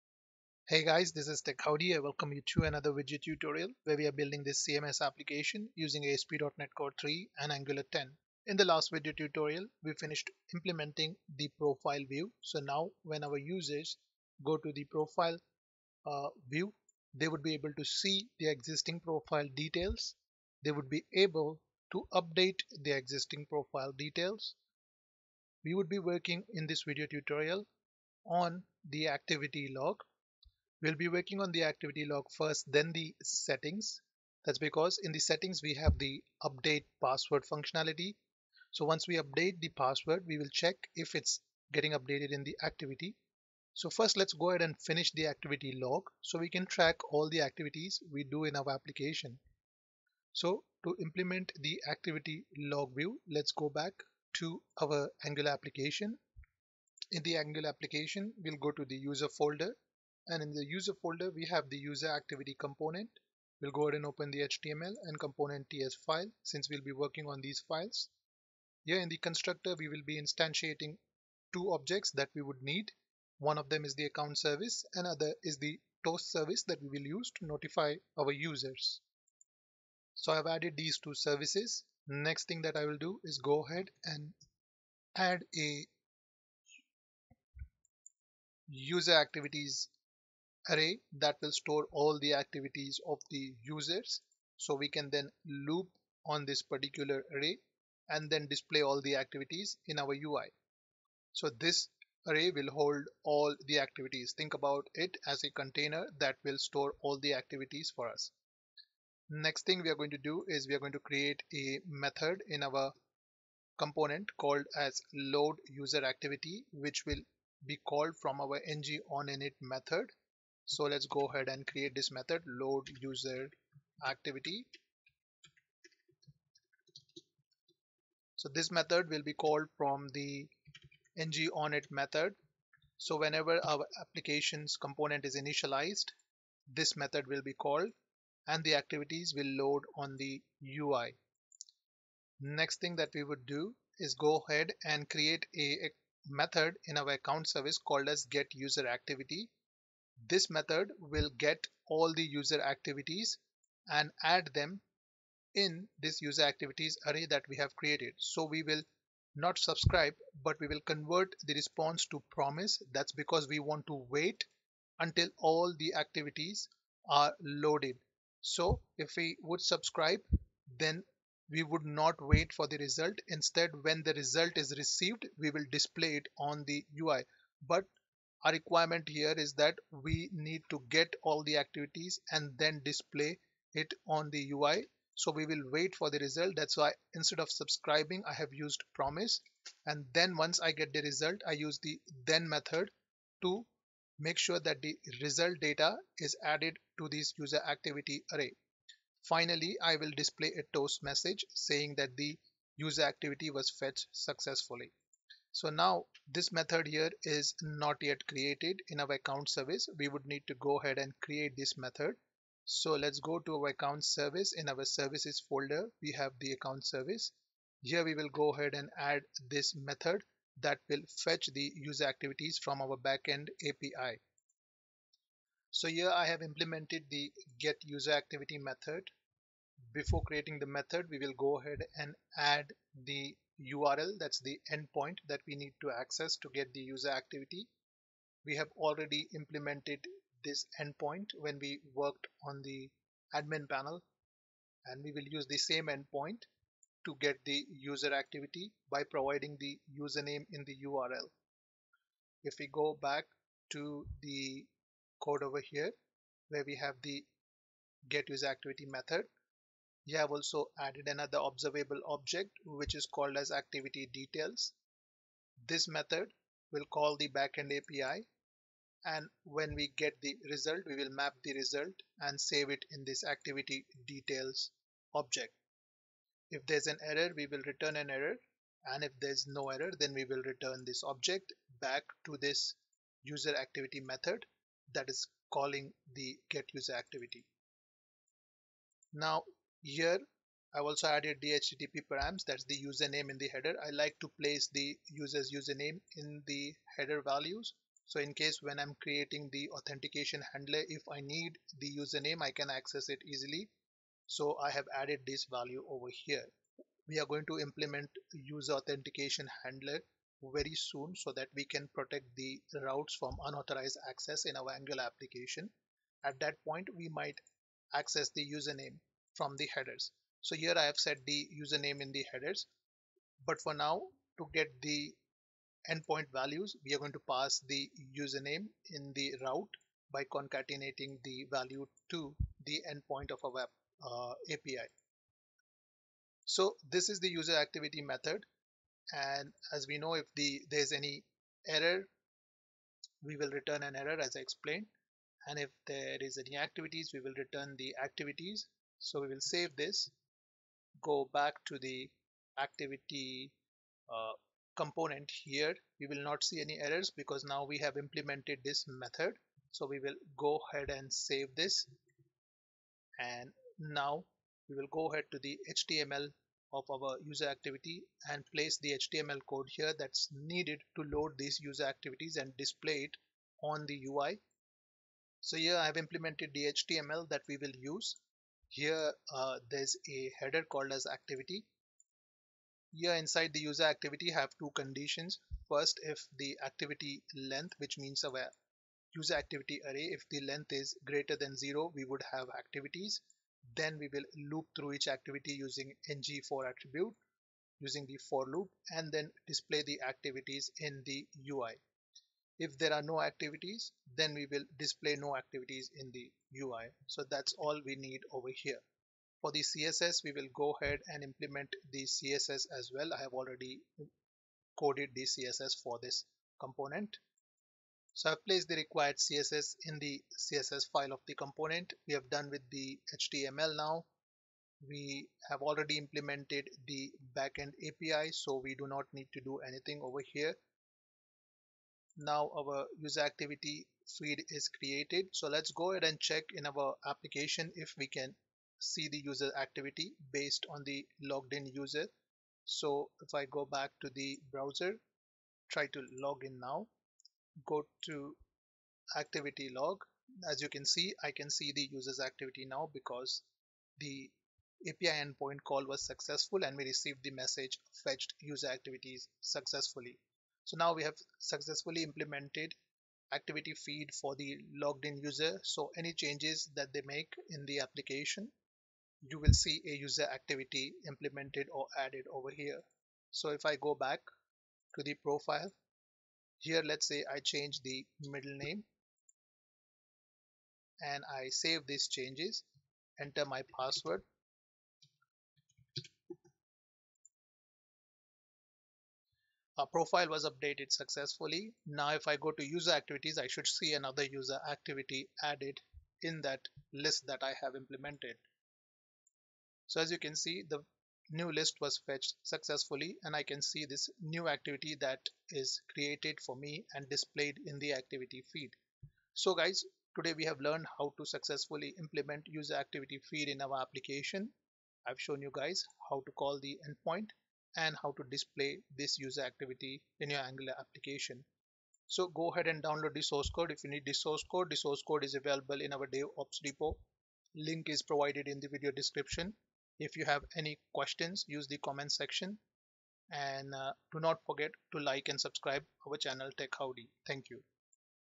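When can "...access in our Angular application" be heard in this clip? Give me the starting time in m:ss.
5:14.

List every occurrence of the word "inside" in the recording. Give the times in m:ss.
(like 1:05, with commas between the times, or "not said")
6:23.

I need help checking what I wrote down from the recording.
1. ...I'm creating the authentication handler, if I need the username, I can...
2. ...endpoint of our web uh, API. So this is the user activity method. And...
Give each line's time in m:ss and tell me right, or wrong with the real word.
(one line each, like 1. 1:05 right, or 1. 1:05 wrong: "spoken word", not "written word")
1. 4:58 right
2. 5:32 right.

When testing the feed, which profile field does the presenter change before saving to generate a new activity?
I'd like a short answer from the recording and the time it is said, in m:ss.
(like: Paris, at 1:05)
Middle name, at 7:58.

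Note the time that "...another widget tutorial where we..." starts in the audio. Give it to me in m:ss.
0:02.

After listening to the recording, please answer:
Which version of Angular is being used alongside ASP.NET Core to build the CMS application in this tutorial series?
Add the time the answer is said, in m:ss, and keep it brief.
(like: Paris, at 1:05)
10, at 0:07.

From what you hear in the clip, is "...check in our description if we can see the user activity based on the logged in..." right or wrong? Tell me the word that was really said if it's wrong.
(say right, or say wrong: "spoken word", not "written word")
wrong: "application", not "description".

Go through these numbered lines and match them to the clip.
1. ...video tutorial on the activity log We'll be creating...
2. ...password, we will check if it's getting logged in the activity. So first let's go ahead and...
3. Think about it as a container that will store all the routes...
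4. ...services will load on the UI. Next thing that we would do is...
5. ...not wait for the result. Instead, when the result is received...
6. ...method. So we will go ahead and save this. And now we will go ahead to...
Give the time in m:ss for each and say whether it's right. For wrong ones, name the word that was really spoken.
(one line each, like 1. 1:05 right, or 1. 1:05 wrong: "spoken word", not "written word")
1. 0:26 wrong: "working", not "creating"
2. 0:39 wrong: "updated", not "logged"
3. 1:44 wrong: "activities", not "routes"
4. 2:18 wrong: "activities", not "services"
5. 2:51 right
6. 5:58 right.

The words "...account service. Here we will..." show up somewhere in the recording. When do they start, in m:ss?
3:36.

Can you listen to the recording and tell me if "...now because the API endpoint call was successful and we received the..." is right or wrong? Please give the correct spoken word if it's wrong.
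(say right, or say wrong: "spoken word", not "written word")
right.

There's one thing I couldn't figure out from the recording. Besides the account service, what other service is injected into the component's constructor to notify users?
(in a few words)
Toast service.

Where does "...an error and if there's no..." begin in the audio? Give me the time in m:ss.
4:37.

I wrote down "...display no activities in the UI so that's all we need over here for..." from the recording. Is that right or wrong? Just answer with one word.
right.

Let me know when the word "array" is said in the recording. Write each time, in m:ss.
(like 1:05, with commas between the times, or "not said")
1:30, 1:37, 1:42, 2:37, 3:18, 6:29.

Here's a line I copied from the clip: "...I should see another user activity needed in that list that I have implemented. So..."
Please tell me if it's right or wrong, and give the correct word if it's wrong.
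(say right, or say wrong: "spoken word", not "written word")
wrong: "added", not "needed".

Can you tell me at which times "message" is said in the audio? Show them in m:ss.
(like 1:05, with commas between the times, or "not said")
3:21, 7:37.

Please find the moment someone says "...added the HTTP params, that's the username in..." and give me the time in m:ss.
4:51.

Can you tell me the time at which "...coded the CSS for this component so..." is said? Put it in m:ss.
6:54.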